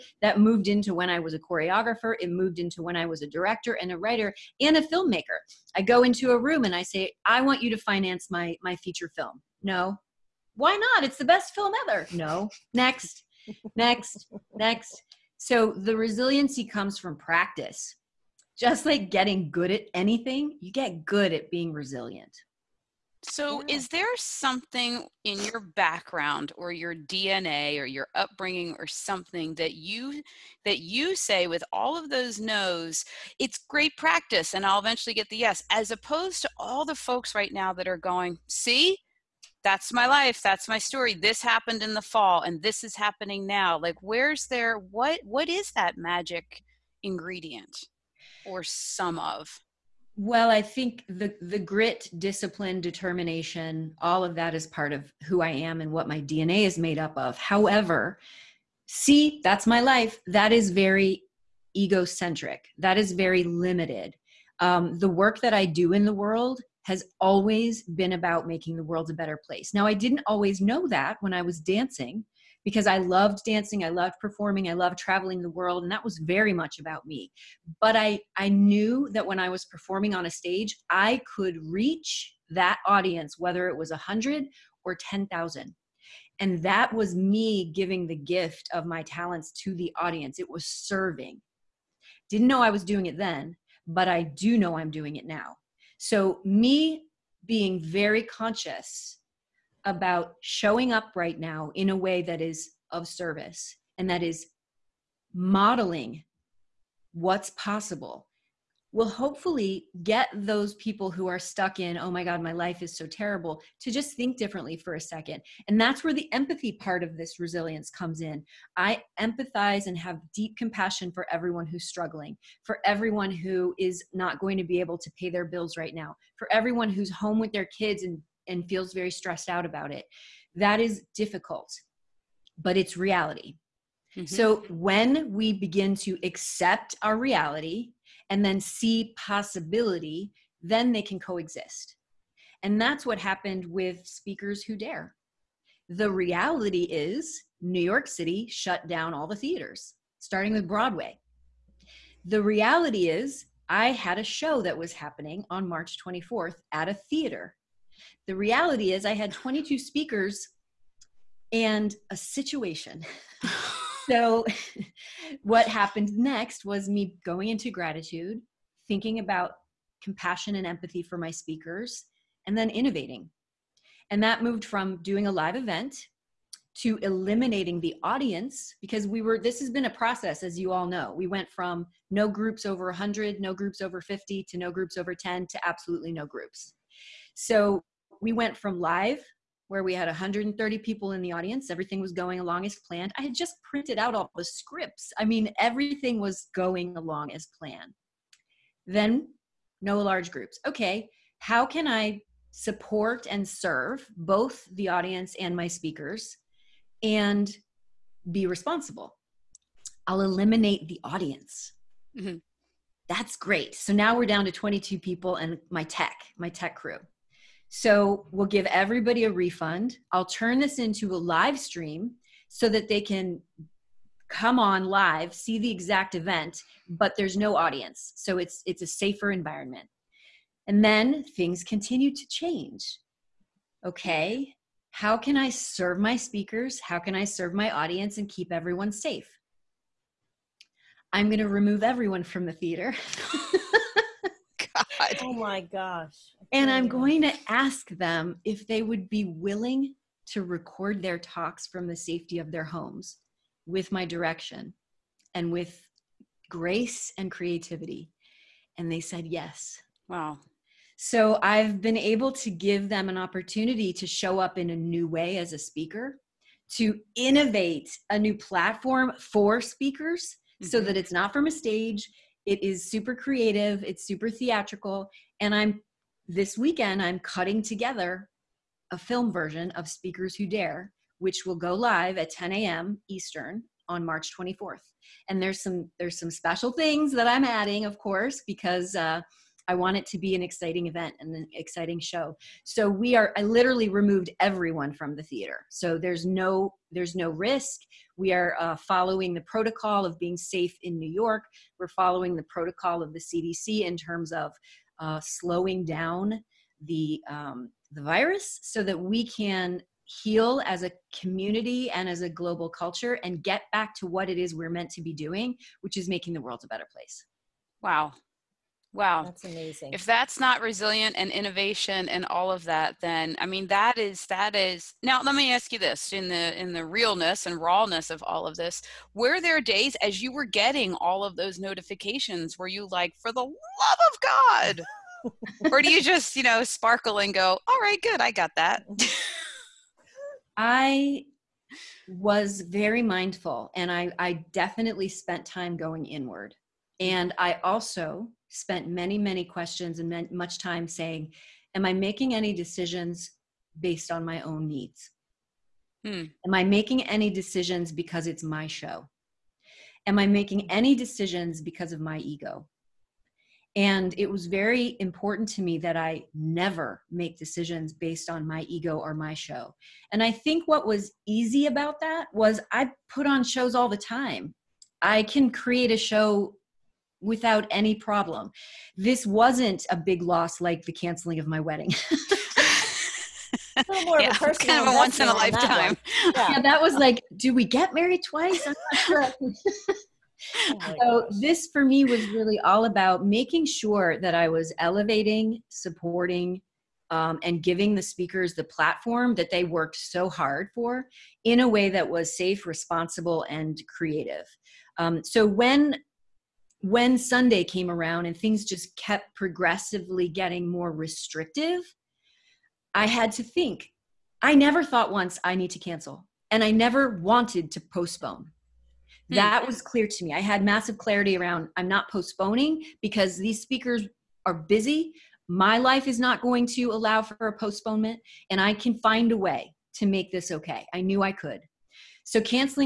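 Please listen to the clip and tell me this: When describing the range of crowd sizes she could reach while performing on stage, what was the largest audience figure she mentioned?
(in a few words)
10,000.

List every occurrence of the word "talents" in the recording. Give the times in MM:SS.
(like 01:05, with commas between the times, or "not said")
01:29.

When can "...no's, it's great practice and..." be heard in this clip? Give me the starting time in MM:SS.
00:32.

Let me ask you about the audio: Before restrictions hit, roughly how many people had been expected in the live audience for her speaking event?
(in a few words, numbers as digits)
130.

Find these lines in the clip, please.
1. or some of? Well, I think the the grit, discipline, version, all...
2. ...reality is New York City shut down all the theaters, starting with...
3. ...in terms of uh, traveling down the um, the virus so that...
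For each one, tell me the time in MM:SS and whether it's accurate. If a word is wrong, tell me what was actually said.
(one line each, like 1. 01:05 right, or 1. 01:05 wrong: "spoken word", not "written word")
1. 00:48 wrong: "determination", not "version"
2. 02:26 right
3. 05:03 wrong: "slowing", not "traveling".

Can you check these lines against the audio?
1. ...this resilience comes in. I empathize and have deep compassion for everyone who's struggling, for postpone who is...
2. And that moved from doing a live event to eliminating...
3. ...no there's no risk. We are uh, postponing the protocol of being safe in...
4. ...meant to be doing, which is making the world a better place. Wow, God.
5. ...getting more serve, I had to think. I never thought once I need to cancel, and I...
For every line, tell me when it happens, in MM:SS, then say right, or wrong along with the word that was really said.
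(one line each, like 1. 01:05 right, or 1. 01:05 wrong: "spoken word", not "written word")
1. 01:57 wrong: "everyone", not "postpone"
2. 02:54 right
3. 04:56 wrong: "following", not "postponing"
4. 05:14 wrong: "Wow", not "God"
5. 06:50 wrong: "restrictive", not "serve".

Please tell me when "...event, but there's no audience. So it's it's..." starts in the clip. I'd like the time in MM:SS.
03:46.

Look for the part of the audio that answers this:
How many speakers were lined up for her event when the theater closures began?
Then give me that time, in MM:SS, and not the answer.
02:39.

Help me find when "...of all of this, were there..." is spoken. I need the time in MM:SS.
05:28.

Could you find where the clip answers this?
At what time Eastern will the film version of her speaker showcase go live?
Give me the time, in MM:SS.
04:42.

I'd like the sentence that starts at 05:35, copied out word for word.
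or do you just, you know, sparkle and go, All right, good, I got that.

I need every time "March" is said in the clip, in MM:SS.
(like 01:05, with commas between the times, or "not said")
02:35, 04:44.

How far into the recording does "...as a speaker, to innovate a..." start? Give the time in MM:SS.
04:25.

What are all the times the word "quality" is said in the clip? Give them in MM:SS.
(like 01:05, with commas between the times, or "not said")
not said.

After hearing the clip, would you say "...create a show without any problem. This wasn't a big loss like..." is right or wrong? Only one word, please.
right.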